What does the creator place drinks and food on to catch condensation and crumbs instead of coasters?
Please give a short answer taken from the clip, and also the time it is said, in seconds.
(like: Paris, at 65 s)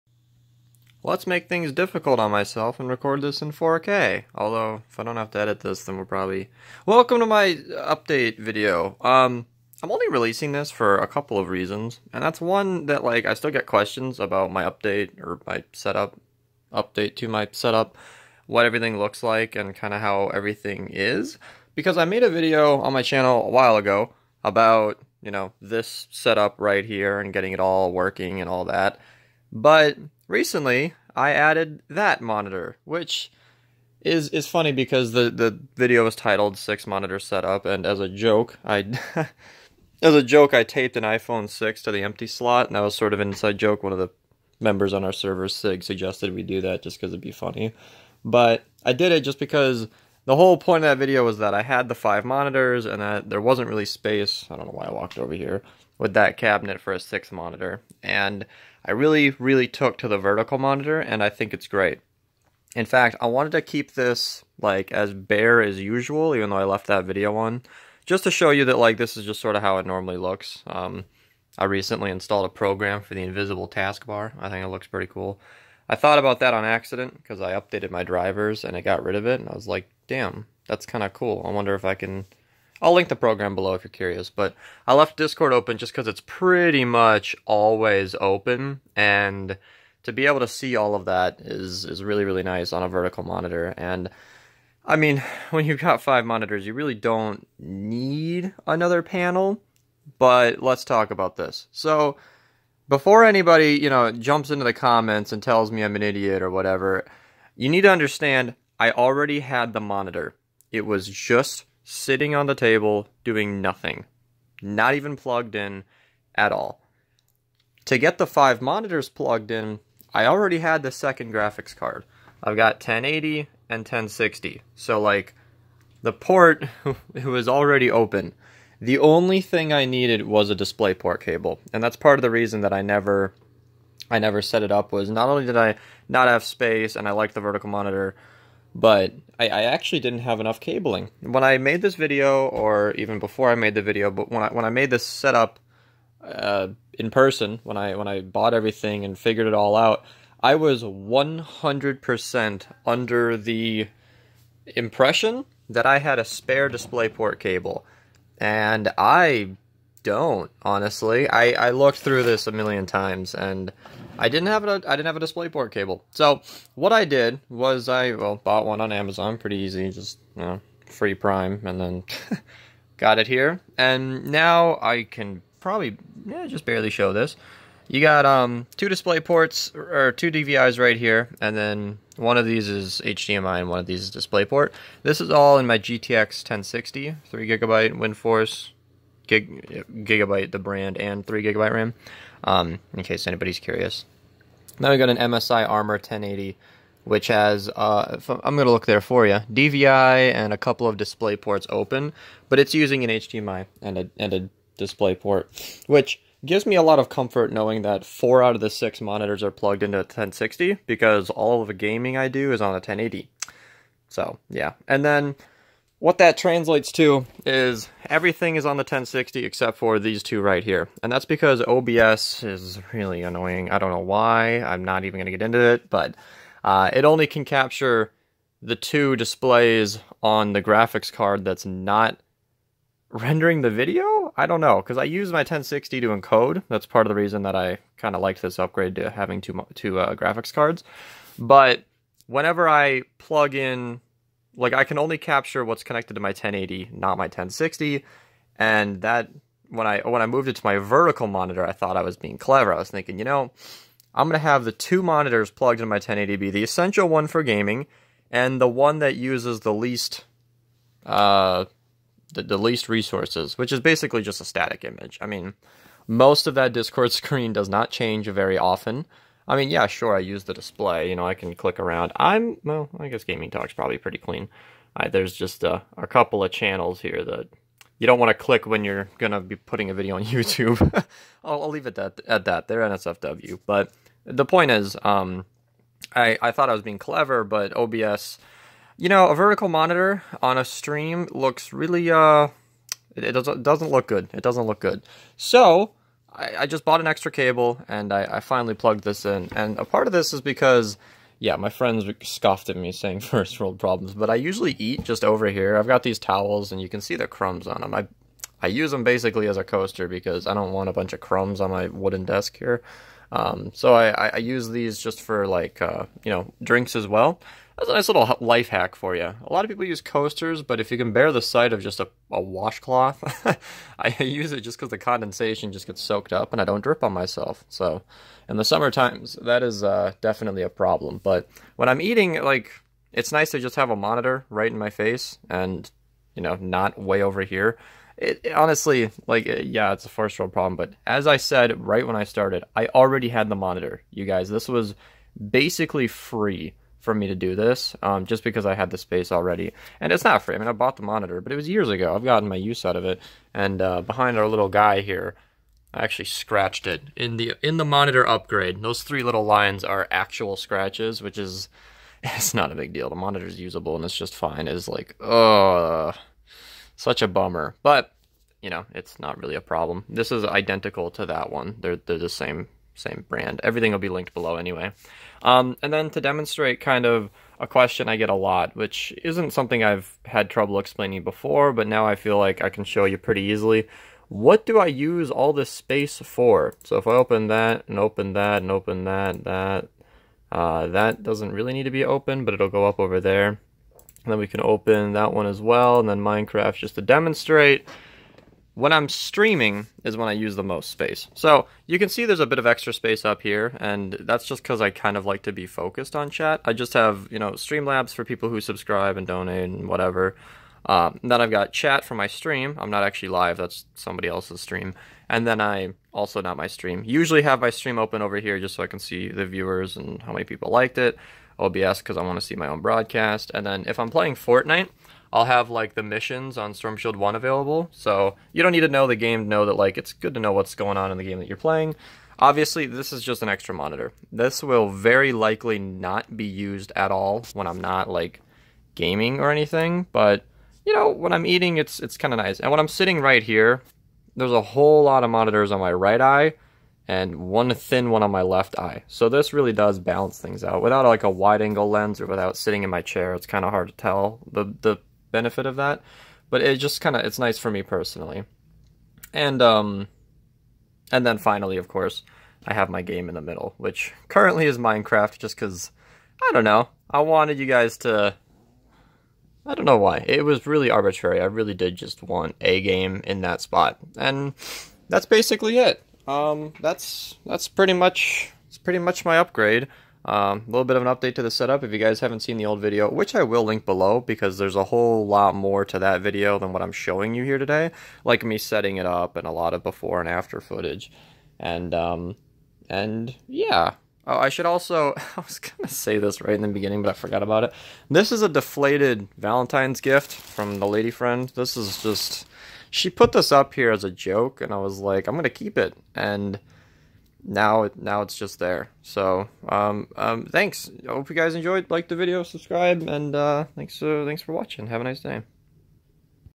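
towels, at 306 s.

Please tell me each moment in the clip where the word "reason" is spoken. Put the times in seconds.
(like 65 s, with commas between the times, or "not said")
11 s, 132 s, 237 s.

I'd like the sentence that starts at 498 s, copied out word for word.
This is a deflated Valentine's gift from the lady friend.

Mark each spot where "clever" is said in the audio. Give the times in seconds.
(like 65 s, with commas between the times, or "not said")
252 s, 286 s.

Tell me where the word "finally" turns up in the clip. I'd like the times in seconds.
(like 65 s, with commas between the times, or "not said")
298 s, 461 s.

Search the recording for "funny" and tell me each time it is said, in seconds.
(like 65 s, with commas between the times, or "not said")
34 s, 47 s.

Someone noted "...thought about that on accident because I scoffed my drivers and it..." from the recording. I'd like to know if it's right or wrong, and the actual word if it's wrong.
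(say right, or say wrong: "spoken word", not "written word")
wrong: "updated", not "scoffed".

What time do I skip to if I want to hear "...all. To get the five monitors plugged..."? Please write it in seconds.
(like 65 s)
116 s.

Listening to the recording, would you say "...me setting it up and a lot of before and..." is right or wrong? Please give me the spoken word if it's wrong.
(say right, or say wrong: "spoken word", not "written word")
right.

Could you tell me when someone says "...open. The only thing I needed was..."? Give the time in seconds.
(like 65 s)
127 s.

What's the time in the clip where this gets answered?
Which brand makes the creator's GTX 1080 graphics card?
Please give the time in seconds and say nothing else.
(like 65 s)
195 s.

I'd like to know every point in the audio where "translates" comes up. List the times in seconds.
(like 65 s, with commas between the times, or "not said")
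216 s.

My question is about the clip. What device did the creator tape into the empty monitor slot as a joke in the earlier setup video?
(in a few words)
iPhone 6.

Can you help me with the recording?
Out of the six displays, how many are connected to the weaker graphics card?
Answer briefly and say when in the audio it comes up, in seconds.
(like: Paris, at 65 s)
4, at 208 s.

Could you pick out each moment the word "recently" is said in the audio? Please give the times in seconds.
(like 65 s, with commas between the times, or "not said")
30 s, 71 s.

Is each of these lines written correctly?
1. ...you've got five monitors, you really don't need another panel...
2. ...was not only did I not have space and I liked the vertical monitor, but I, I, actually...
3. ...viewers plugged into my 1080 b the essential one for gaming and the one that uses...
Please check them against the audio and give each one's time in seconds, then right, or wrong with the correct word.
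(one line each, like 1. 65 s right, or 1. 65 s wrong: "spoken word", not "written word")
1. 95 s right
2. 134 s right
3. 255 s wrong: "monitors", not "viewers".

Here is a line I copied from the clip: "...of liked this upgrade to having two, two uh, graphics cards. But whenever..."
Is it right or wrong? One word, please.
right.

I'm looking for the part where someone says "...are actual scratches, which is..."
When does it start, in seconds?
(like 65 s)
359 s.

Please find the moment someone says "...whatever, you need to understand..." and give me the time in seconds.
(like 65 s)
106 s.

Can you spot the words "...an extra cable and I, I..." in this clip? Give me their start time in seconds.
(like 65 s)
297 s.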